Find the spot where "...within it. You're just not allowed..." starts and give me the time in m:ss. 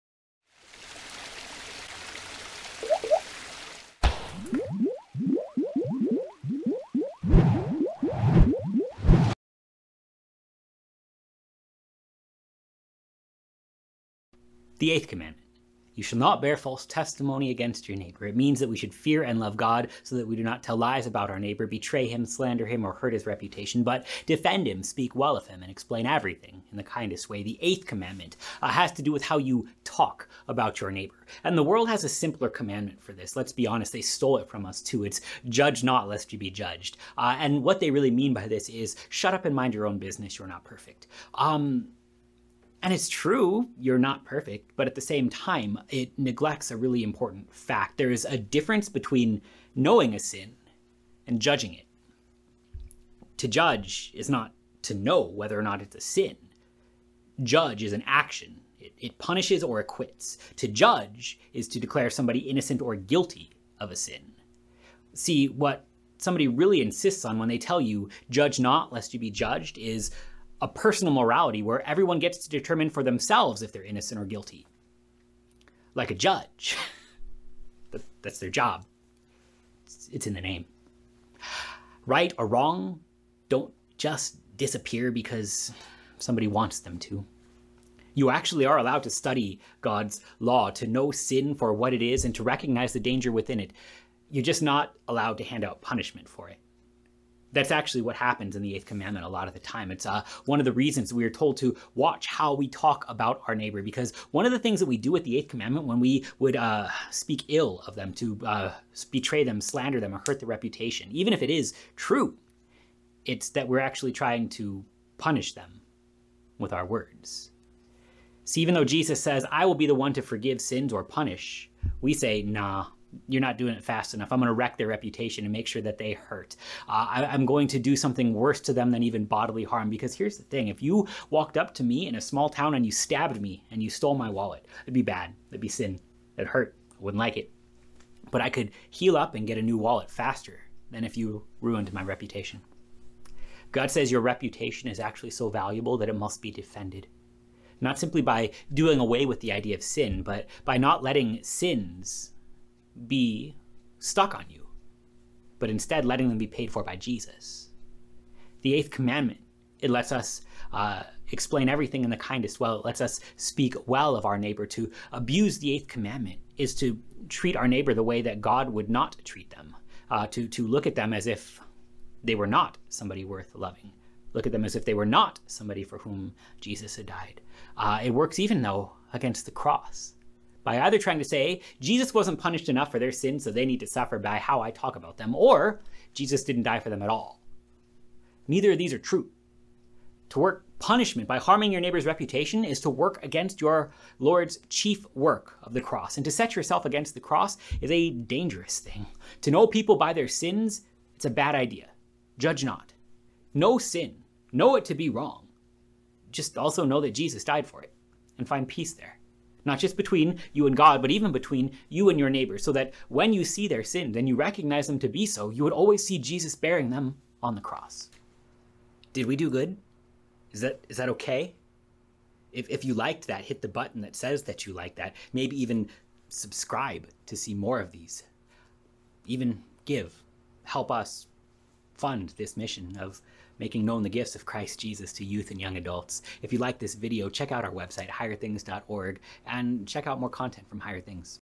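1:33.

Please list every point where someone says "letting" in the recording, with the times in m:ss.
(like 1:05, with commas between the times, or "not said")
2:31, 2:36.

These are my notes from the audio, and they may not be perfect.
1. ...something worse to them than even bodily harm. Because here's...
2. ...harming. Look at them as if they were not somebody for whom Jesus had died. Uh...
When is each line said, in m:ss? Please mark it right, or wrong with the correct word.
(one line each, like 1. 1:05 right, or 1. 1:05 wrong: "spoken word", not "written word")
1. 2:07 right
2. 2:53 wrong: "loving", not "harming".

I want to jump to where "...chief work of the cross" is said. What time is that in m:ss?
3:14.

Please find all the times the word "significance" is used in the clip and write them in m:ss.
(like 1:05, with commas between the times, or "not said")
not said.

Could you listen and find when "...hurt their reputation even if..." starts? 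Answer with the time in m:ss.
1:50.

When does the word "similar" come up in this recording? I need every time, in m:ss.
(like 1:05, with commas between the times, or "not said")
not said.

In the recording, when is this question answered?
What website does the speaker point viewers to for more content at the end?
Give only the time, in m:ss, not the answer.
3:58.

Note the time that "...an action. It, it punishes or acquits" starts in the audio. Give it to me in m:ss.
0:57.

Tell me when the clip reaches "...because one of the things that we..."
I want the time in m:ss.
1:43.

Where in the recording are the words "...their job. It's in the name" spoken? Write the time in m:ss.
1:18.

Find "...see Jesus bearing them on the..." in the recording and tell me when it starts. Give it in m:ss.
3:36.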